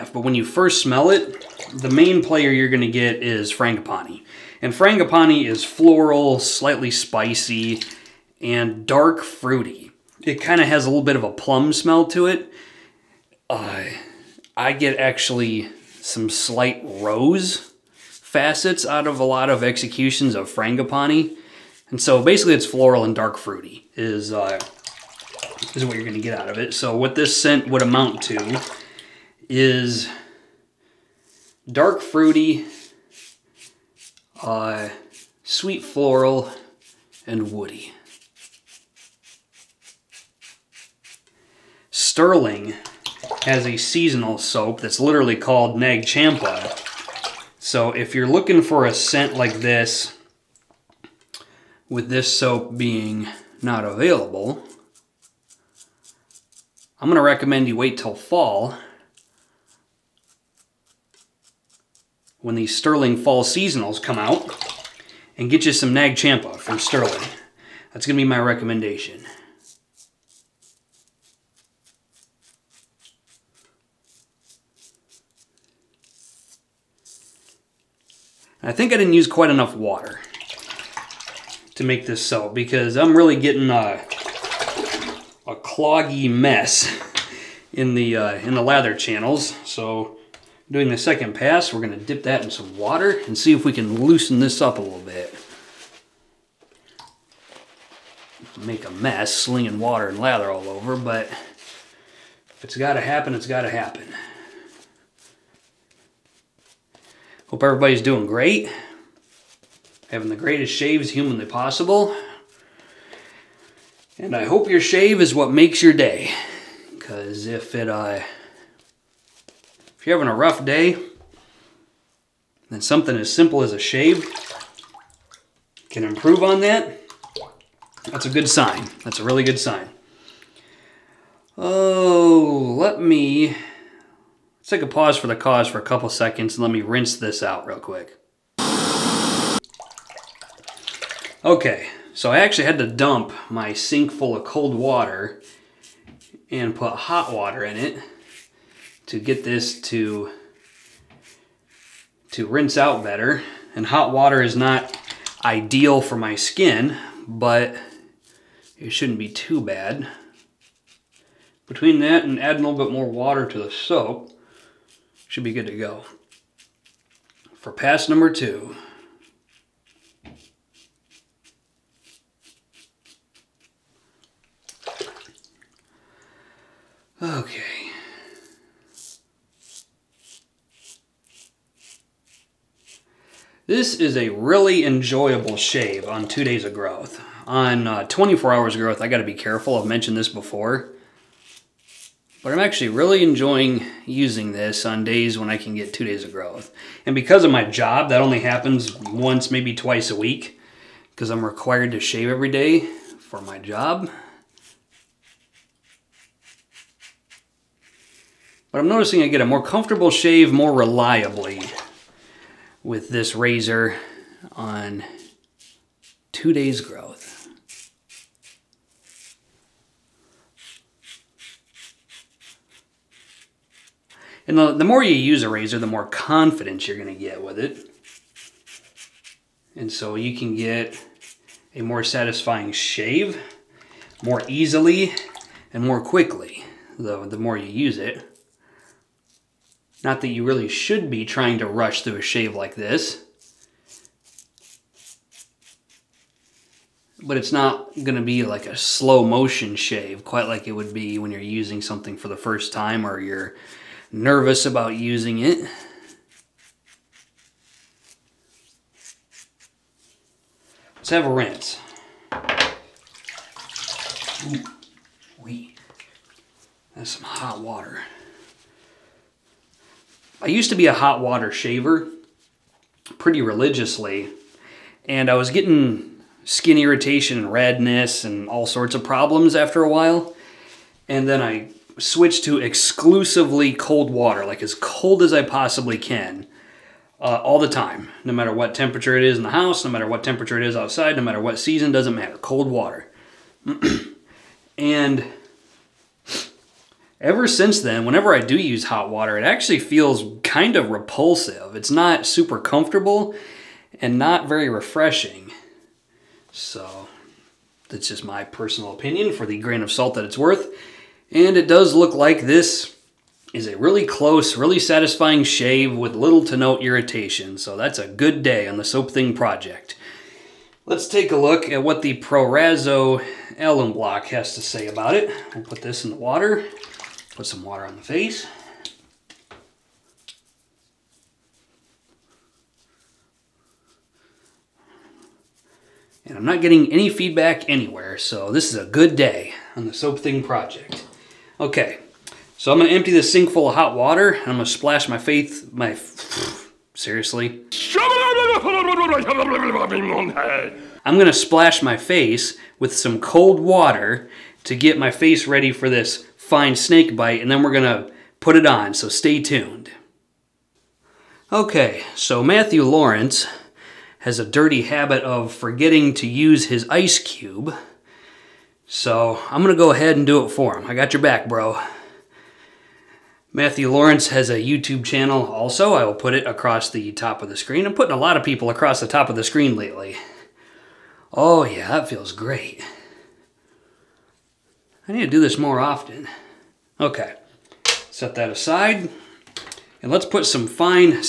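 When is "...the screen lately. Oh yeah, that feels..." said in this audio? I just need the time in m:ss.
6:19.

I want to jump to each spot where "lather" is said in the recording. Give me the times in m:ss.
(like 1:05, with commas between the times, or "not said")
1:28, 1:40.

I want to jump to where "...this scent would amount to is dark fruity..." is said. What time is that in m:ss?
0:27.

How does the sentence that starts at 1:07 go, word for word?
That's going to be my recommendation.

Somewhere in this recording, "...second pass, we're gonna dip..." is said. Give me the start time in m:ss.
1:30.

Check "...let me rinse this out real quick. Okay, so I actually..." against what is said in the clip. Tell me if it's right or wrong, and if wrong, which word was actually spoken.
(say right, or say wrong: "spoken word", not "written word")
right.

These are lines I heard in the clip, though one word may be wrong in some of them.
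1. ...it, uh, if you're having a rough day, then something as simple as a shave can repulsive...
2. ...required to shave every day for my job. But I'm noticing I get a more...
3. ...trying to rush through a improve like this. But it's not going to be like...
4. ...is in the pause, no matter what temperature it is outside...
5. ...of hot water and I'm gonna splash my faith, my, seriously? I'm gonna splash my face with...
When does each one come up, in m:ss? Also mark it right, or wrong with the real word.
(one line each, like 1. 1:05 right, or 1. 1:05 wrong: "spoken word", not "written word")
1. 1:57 wrong: "improve", not "repulsive"
2. 3:21 right
3. 4:01 wrong: "shave", not "improve"
4. 4:49 wrong: "house", not "pause"
5. 5:43 right.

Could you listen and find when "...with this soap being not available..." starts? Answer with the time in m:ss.
0:51.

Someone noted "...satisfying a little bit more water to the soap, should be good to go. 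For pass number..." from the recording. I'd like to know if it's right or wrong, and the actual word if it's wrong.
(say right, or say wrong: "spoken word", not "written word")
wrong: "adding", not "satisfying".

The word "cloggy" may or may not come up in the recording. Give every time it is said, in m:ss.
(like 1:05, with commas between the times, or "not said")
1:25.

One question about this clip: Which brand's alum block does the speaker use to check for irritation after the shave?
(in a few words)
Proraso.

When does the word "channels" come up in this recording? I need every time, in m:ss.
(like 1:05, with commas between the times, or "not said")
1:28, 6:15.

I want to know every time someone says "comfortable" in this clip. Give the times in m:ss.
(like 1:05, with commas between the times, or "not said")
3:29, 5:02.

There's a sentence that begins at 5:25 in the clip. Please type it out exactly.
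We'll put this in the water, put some water on the face.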